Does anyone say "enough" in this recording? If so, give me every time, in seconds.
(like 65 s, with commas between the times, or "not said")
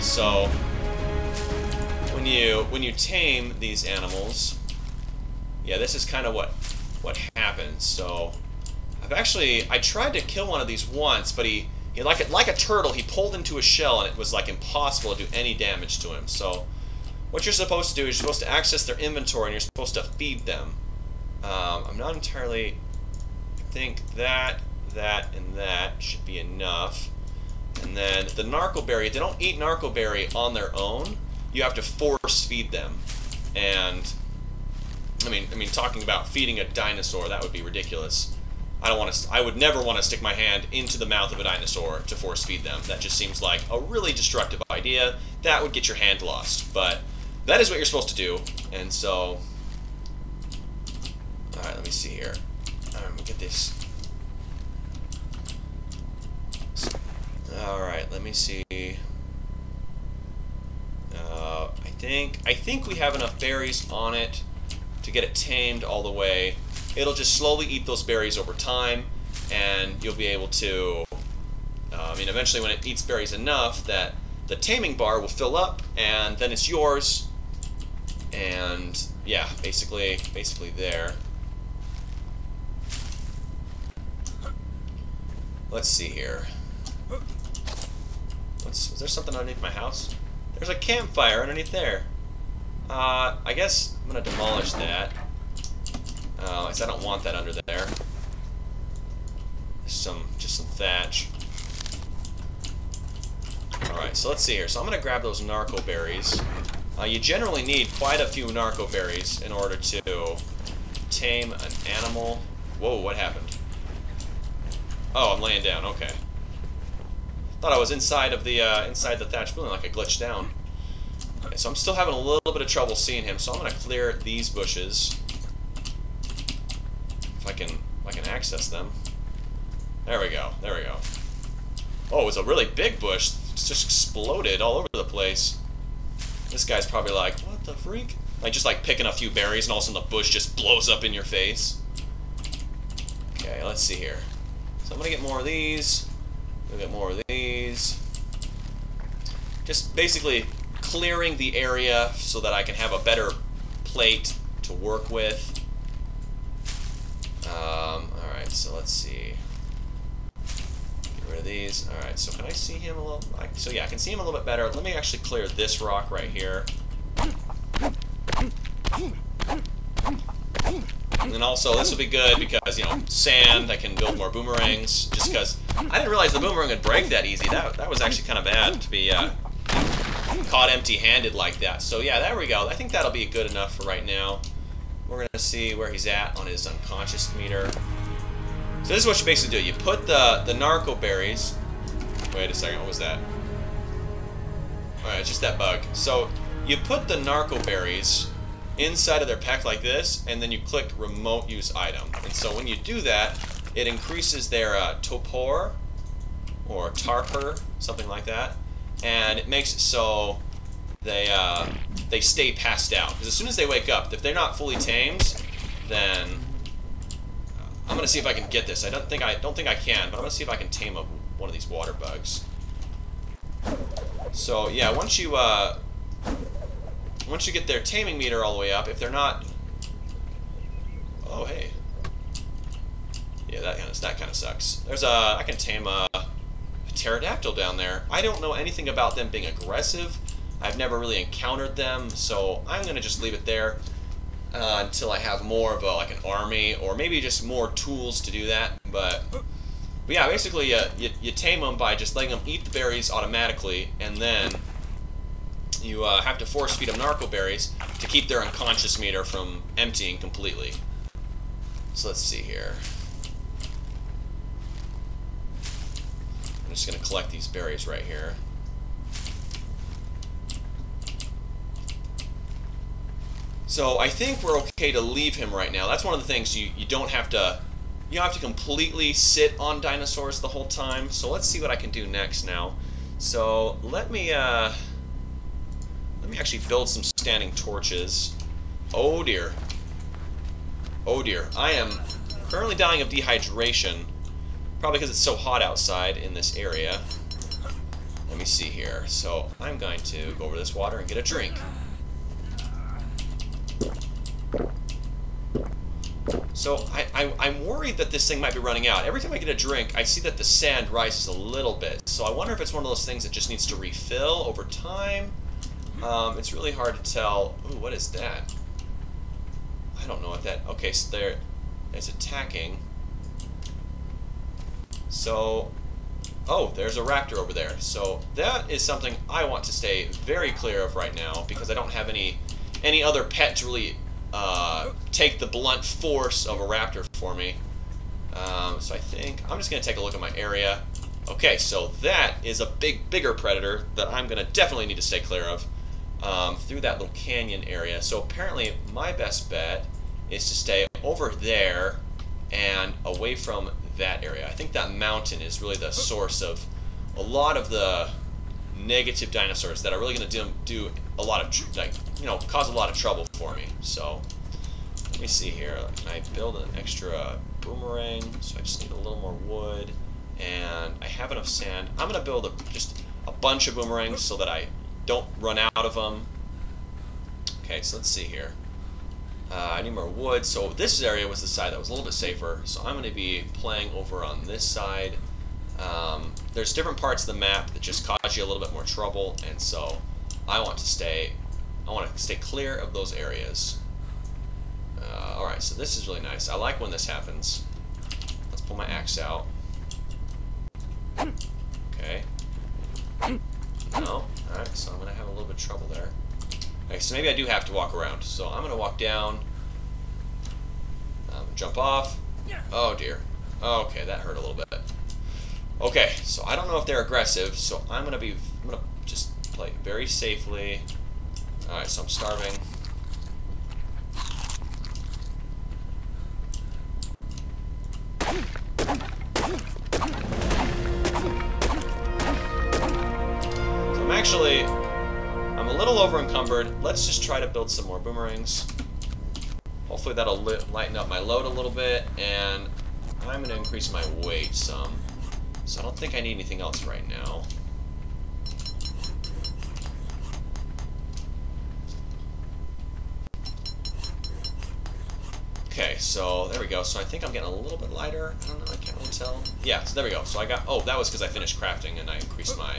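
26 s, 63 s, 73 s, 183 s, 371 s.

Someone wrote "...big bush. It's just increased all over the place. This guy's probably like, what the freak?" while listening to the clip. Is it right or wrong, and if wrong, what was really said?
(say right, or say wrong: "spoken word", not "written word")
wrong: "exploded", not "increased".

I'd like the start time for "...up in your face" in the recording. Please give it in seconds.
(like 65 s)
140 s.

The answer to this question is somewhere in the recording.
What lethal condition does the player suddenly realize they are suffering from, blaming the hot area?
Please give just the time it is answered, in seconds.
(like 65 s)
293 s.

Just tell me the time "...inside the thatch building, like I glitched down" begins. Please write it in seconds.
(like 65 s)
118 s.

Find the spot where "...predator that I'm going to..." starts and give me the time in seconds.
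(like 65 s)
343 s.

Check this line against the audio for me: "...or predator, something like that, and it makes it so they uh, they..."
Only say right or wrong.
wrong.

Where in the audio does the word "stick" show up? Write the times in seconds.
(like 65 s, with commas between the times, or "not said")
40 s.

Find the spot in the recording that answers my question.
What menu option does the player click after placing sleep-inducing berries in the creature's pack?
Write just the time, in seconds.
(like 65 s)
200 s.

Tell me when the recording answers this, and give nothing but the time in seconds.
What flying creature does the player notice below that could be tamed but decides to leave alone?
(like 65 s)
236 s.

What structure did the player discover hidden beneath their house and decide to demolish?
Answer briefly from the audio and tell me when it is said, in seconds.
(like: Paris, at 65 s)
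A campfire, at 90 s.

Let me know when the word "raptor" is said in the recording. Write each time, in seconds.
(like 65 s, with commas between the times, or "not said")
326 s, 336 s.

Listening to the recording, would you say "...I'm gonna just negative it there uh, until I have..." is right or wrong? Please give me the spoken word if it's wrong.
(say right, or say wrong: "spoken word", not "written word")
wrong: "leave", not "negative".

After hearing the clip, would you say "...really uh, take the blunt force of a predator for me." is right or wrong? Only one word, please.
wrong.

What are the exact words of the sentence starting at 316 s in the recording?
Um, it's really hard to tell.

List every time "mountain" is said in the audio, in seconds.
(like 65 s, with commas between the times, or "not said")
354 s.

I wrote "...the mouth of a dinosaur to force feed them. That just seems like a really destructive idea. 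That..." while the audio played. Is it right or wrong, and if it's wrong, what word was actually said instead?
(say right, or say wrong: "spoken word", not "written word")
right.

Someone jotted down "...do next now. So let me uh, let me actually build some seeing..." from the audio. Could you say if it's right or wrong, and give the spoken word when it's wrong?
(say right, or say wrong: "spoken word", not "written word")
wrong: "standing", not "seeing".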